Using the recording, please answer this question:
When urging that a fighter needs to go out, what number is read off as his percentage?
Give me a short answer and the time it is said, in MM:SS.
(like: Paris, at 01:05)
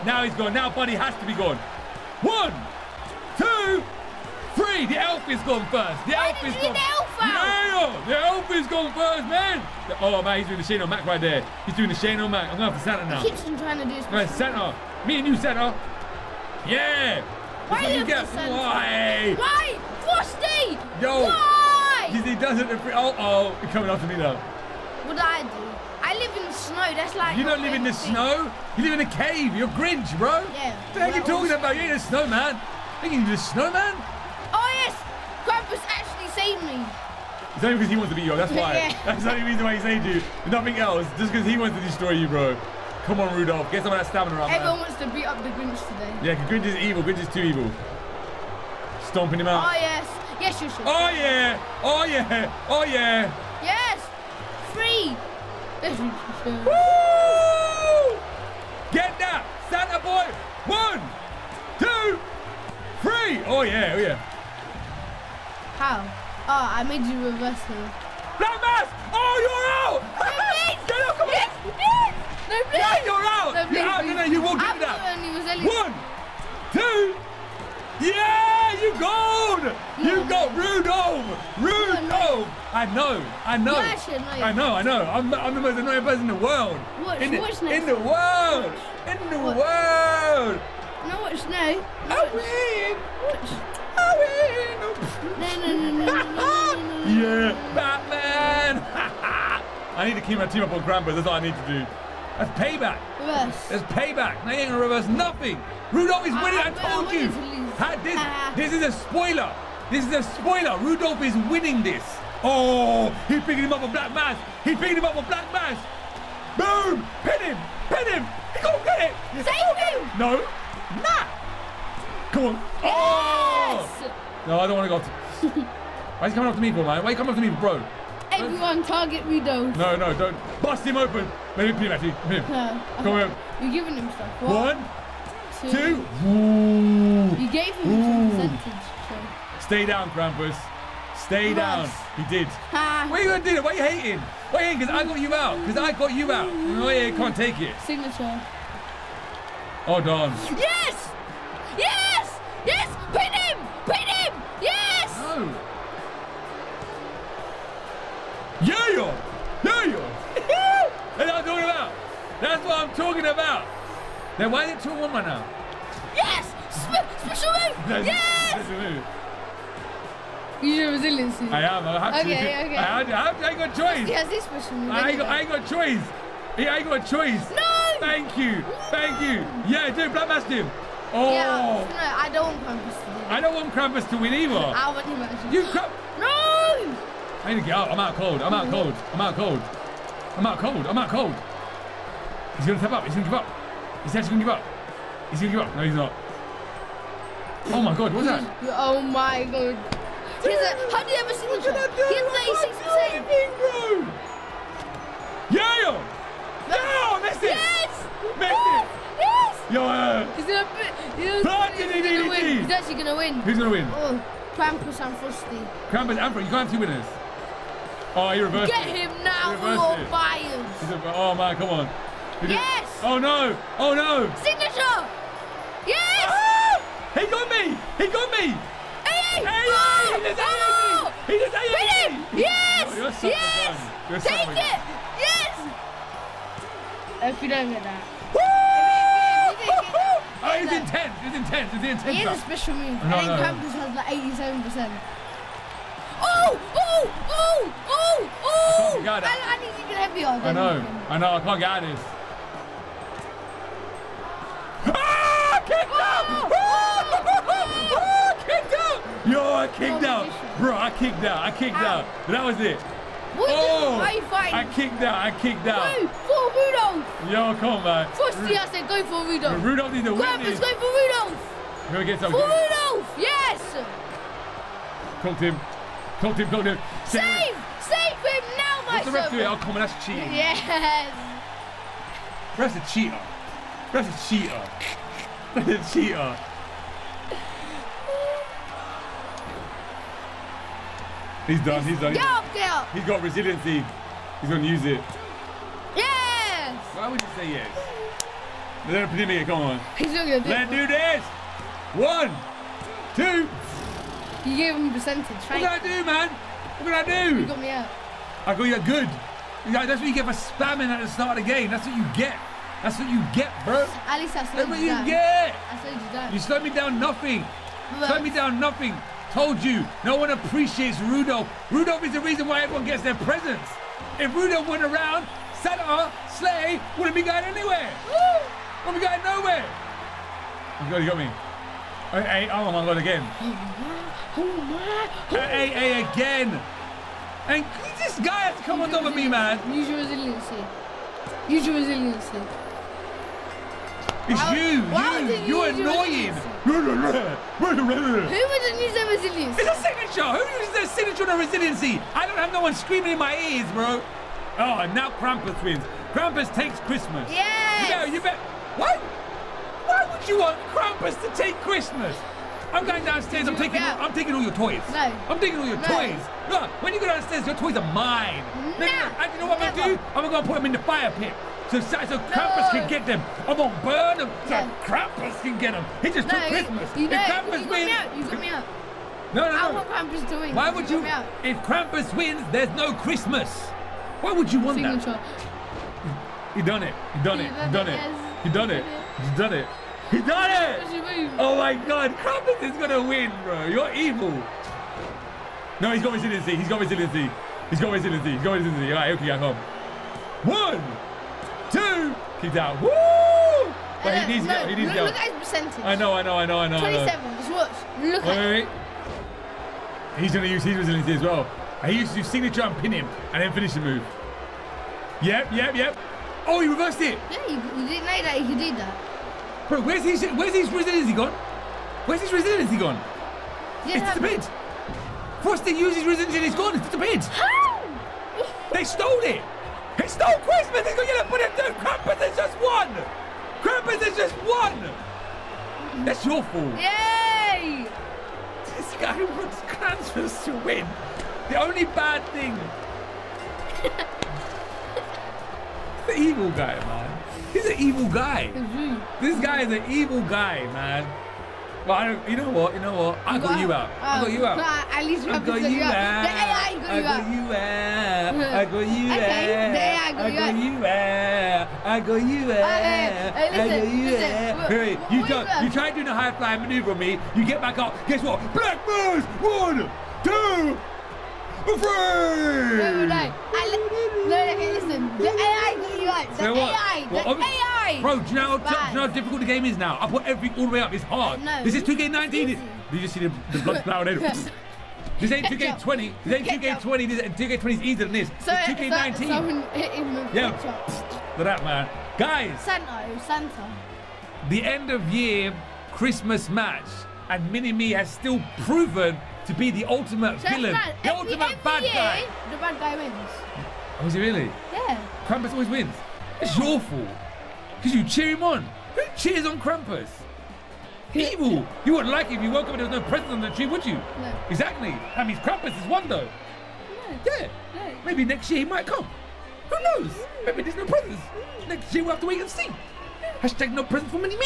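27, at 06:46.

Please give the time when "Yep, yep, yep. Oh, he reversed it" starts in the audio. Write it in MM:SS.
06:55.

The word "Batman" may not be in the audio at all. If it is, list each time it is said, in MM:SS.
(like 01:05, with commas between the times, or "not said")
01:37.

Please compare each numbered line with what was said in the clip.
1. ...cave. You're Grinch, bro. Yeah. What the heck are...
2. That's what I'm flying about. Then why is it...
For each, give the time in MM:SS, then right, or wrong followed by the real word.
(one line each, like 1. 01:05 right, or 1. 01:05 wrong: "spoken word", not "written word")
1. 00:29 right
2. 02:42 wrong: "talking", not "flying".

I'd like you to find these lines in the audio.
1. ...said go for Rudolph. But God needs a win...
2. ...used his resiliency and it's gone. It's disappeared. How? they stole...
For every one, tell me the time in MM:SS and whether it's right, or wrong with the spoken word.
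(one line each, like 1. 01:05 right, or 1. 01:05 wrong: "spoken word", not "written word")
1. 04:28 wrong: "Rudolph", not "God"
2. 07:05 right.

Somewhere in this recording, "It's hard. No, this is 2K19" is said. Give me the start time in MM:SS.
08:00.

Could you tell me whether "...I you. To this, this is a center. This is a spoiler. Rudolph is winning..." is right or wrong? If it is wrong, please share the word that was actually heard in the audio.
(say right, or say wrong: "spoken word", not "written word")
wrong: "spoiler", not "center".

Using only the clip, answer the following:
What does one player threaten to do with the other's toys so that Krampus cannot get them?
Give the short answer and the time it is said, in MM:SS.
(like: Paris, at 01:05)
Put them in the fire pit, at 06:10.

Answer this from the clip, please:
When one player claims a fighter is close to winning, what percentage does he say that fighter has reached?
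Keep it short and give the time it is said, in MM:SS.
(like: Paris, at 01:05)
86%, at 03:22.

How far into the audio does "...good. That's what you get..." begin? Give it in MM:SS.
05:08.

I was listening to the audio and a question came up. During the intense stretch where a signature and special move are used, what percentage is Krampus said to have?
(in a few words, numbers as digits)
87%.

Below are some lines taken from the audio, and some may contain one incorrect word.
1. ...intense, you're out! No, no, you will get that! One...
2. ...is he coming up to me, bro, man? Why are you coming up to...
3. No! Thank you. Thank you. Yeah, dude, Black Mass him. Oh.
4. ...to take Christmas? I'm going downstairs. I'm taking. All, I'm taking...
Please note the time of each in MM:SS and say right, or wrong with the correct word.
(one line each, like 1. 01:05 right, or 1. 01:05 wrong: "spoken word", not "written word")
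1. 01:13 wrong: "please", not "intense"
2. 02:06 right
3. 02:57 right
4. 06:01 right.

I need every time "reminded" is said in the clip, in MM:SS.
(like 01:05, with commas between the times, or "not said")
not said.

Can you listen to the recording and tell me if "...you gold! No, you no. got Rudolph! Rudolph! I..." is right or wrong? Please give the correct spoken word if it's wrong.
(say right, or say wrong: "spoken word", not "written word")
right.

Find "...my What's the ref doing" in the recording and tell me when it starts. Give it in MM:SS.
04:38.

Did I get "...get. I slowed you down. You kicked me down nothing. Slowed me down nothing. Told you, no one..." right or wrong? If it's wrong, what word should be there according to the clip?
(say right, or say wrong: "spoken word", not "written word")
wrong: "slowed", not "kicked".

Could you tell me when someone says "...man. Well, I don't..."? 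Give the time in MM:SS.
07:30.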